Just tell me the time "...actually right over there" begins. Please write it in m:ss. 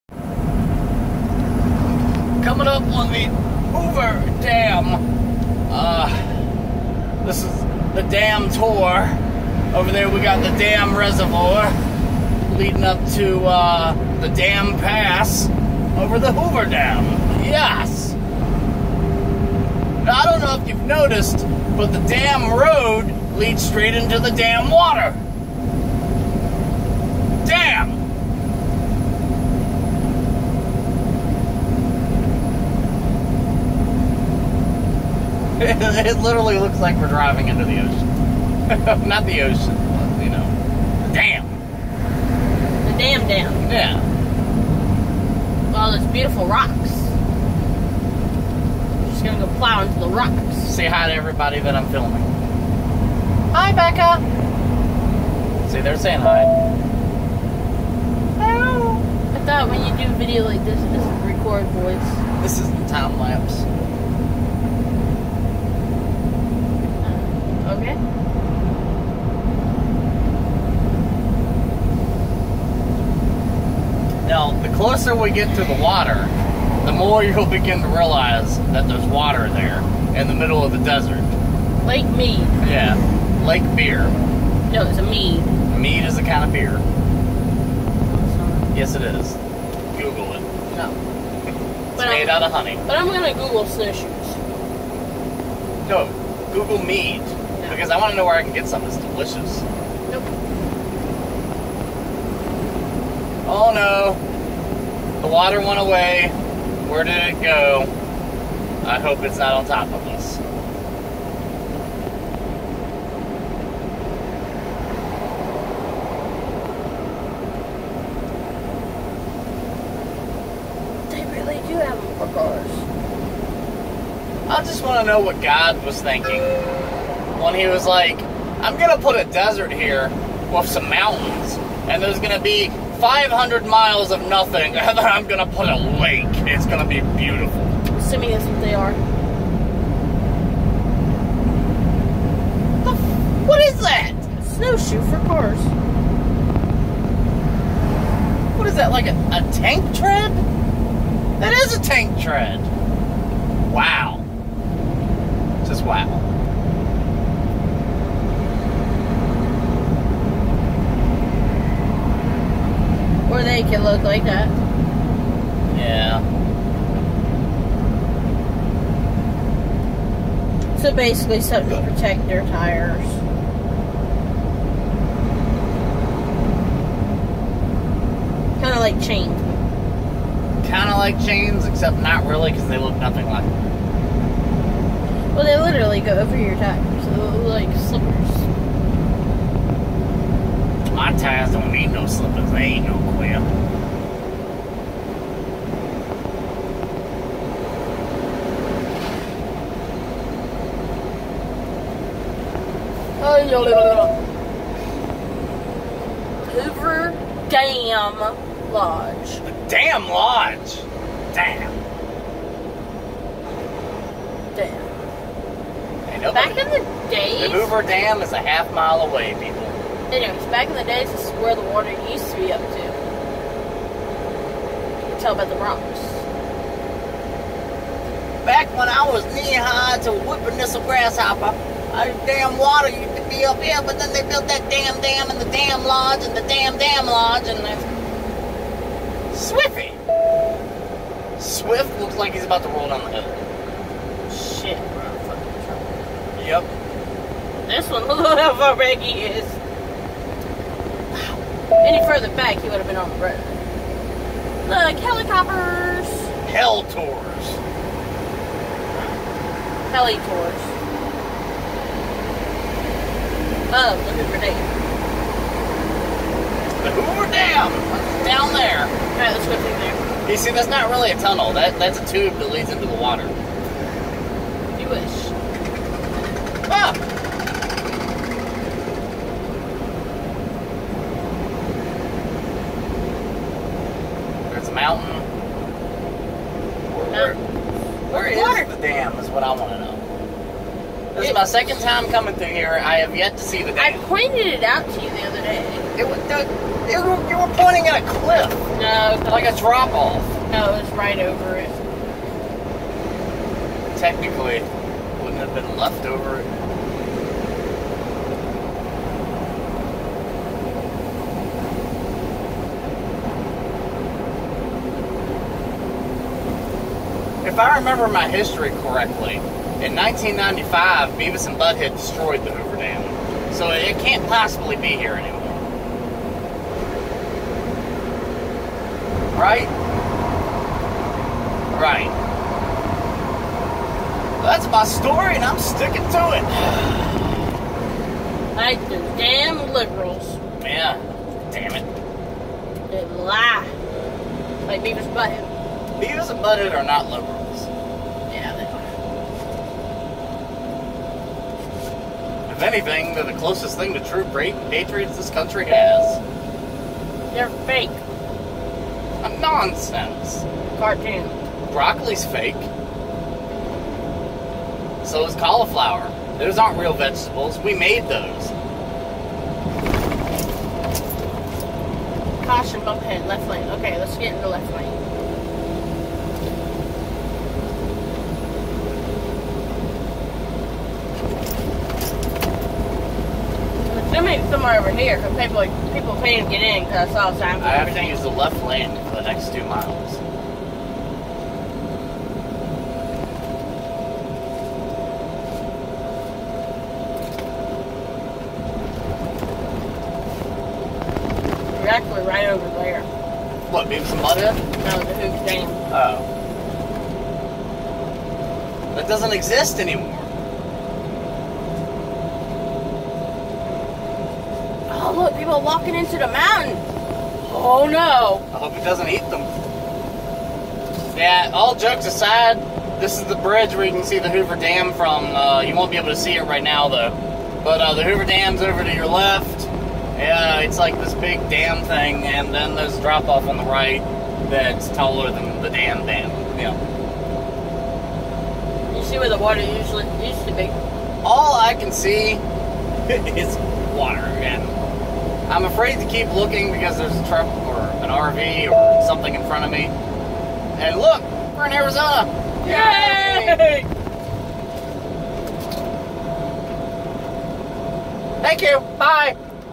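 6:41.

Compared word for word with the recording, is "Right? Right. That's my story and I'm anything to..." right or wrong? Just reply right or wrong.
wrong.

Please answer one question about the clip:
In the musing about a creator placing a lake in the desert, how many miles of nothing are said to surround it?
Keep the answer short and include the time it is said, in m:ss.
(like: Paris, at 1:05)
500, at 2:13.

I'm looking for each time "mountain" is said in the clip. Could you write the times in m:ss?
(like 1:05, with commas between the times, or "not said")
2:10, 4:44, 6:56.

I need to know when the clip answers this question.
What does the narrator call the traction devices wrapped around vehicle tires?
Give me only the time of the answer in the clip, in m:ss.
2:24.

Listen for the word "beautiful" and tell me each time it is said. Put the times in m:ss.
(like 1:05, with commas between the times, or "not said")
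0:46, 2:17.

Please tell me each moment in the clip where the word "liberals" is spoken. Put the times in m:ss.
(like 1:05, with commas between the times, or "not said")
5:39, 5:47.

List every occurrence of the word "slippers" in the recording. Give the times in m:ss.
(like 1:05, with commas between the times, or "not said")
3:07, 3:12.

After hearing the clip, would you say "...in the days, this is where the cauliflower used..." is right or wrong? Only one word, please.
wrong.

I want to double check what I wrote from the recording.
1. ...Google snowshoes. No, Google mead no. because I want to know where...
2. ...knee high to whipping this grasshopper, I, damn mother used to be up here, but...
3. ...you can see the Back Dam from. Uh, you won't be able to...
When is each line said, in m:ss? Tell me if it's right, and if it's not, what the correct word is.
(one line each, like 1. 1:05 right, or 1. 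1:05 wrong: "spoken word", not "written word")
1. 1:33 right
2. 3:49 wrong: "water", not "mother"
3. 7:03 wrong: "Hoover", not "Back".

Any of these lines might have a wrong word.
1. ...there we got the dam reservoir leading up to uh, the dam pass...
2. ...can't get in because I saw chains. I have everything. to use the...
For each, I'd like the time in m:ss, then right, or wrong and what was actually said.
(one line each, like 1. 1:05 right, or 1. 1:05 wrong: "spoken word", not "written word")
1. 0:09 right
2. 6:26 wrong: "signs", not "chains".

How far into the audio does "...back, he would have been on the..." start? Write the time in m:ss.
4:12.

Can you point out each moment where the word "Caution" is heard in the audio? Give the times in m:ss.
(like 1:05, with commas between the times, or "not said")
6:12.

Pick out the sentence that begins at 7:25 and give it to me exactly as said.
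I'm afraid to keep looking because there's a truck or an RV or something in front of me.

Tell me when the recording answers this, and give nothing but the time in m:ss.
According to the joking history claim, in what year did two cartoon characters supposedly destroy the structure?
5:19.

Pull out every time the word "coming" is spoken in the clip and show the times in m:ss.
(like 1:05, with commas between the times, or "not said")
0:02, 4:52.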